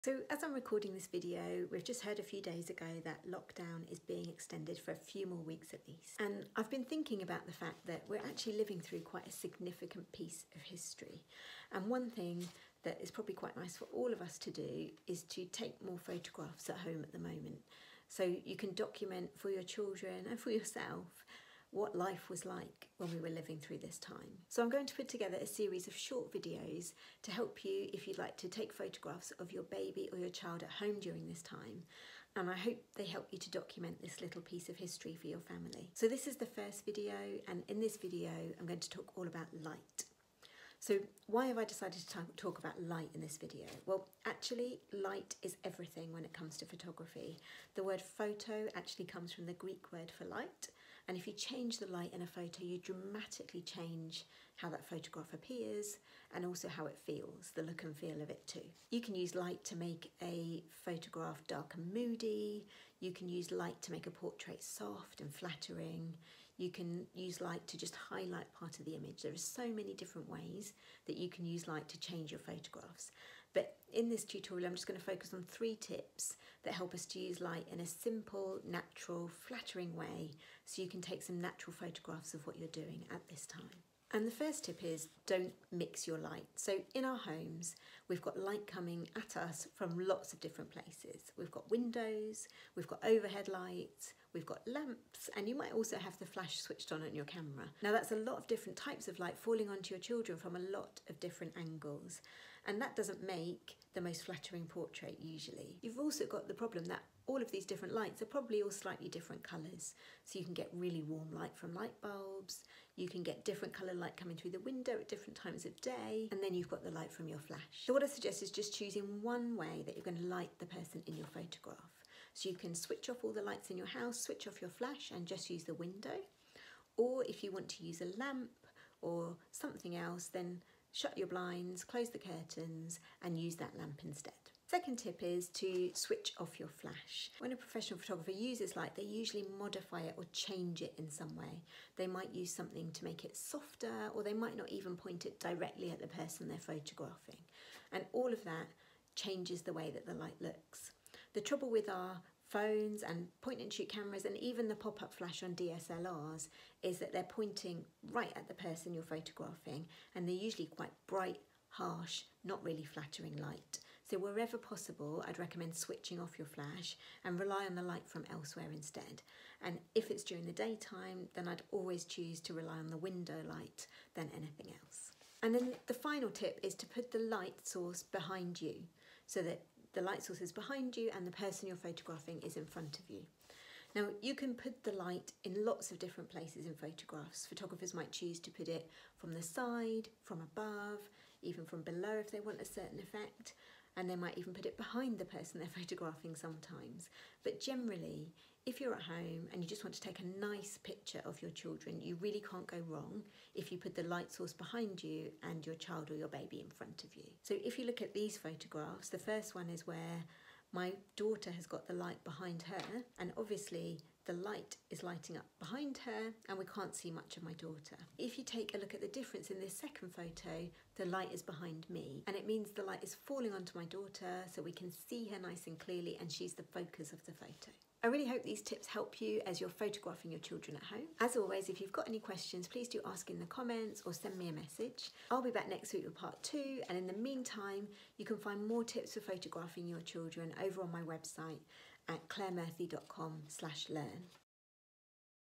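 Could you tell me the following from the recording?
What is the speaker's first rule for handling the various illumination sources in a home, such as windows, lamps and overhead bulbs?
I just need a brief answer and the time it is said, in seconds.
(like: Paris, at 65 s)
Don't mix your light, at 85 s.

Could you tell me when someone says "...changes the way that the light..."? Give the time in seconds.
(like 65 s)
149 s.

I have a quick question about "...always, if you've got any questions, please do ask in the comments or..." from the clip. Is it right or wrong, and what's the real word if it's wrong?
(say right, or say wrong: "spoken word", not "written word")
right.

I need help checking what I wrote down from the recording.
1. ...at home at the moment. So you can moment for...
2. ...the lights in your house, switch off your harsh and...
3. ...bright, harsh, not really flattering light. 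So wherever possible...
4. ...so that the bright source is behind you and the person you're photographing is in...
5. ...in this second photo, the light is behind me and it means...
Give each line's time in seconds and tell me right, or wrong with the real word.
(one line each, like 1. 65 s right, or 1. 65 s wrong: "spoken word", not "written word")
1. 16 s wrong: "document", not "moment"
2. 123 s wrong: "flash", not "harsh"
3. 161 s right
4. 179 s wrong: "light", not "bright"
5. 219 s right.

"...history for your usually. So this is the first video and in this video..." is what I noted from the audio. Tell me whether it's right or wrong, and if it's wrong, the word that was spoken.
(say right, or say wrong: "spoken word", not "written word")
wrong: "family", not "usually".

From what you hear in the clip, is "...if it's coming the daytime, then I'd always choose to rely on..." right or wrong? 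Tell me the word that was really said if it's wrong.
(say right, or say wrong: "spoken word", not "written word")
wrong: "during", not "coming".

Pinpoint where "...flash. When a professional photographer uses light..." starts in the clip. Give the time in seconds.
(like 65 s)
136 s.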